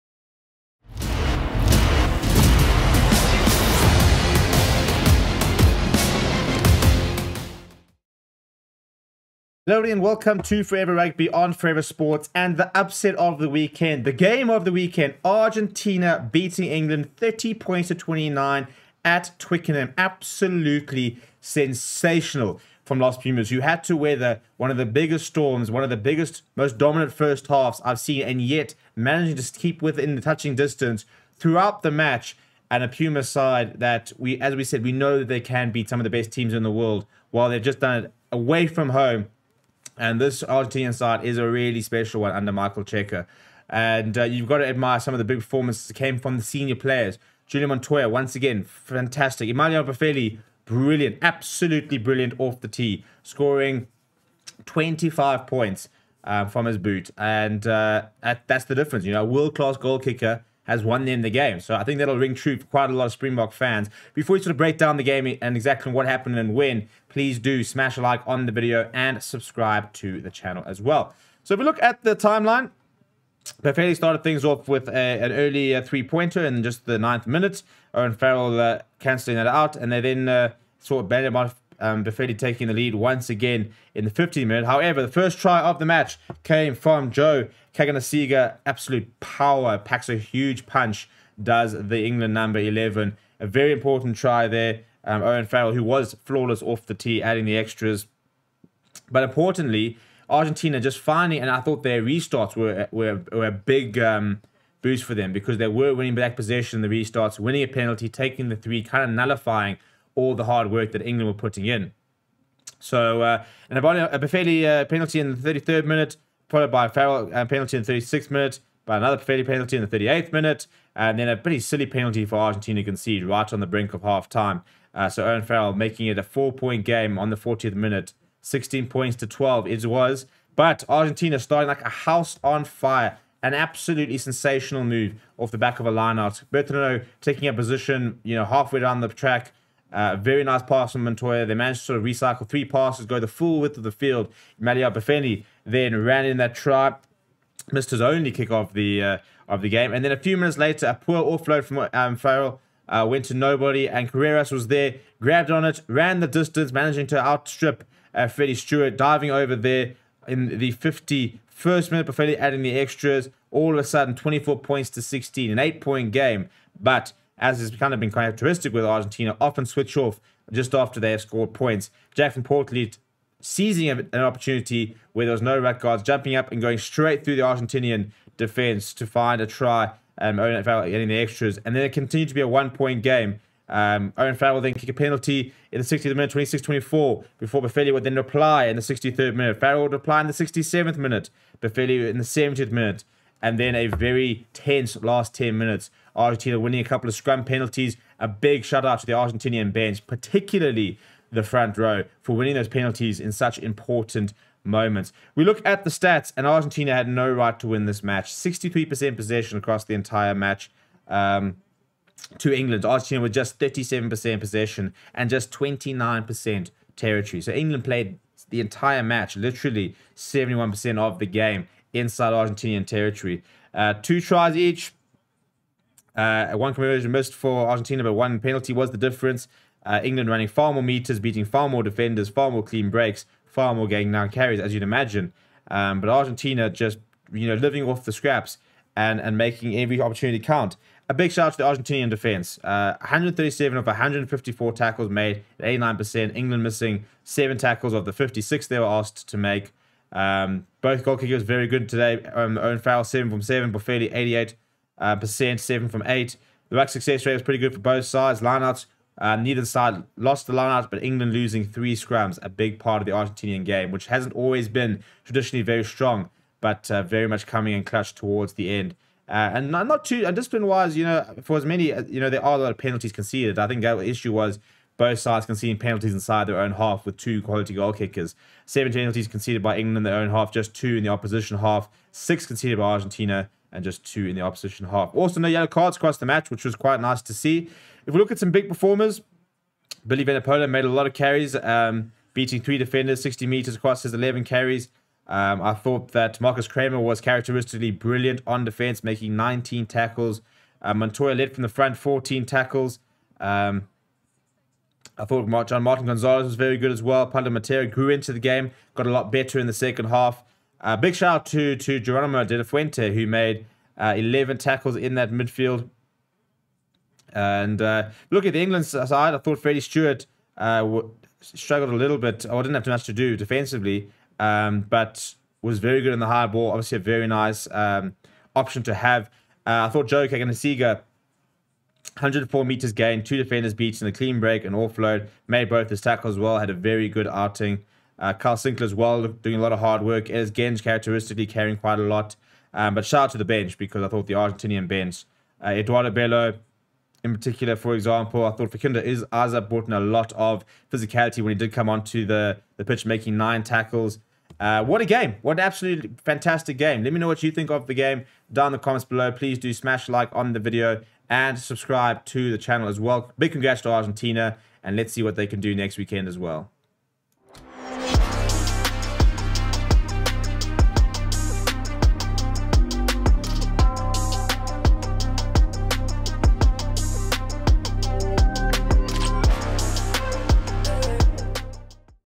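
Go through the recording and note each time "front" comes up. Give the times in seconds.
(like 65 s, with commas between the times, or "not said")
201 s, 301 s.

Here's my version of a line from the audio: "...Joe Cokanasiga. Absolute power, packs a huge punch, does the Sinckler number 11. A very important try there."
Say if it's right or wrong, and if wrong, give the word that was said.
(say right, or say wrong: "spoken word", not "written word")
wrong: "England", not "Sinckler".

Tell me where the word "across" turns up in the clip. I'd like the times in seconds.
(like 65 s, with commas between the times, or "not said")
209 s, 285 s, 293 s.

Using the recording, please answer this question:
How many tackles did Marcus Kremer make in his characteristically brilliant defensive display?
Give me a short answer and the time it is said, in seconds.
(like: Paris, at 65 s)
19, at 299 s.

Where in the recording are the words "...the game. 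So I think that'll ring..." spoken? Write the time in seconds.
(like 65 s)
61 s.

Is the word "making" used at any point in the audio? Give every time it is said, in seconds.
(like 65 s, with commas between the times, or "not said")
125 s, 239 s, 299 s, 353 s.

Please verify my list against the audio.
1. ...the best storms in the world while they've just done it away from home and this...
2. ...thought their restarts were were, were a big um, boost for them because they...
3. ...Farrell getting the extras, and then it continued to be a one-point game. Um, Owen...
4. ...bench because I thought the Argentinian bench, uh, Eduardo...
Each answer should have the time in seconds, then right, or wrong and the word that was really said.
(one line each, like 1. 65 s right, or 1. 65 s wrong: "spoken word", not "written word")
1. 36 s wrong: "teams", not "storms"
2. 101 s right
3. 180 s right
4. 343 s right.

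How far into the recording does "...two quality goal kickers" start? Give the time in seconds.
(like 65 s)
277 s.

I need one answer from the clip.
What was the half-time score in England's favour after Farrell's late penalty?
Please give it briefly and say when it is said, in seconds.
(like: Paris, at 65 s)
16-12, at 128 s.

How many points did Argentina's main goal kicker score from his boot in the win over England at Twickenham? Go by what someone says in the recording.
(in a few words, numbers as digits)
25.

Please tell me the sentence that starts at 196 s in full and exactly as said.
Argentina winning a couple of scrum penalties.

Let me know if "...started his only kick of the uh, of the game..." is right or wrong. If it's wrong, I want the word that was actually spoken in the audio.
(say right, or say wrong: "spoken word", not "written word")
wrong: "missed", not "started".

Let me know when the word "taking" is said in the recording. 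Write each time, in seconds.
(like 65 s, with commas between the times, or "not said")
82 s, 108 s, 137 s.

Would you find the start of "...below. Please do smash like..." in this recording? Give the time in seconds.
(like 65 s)
359 s.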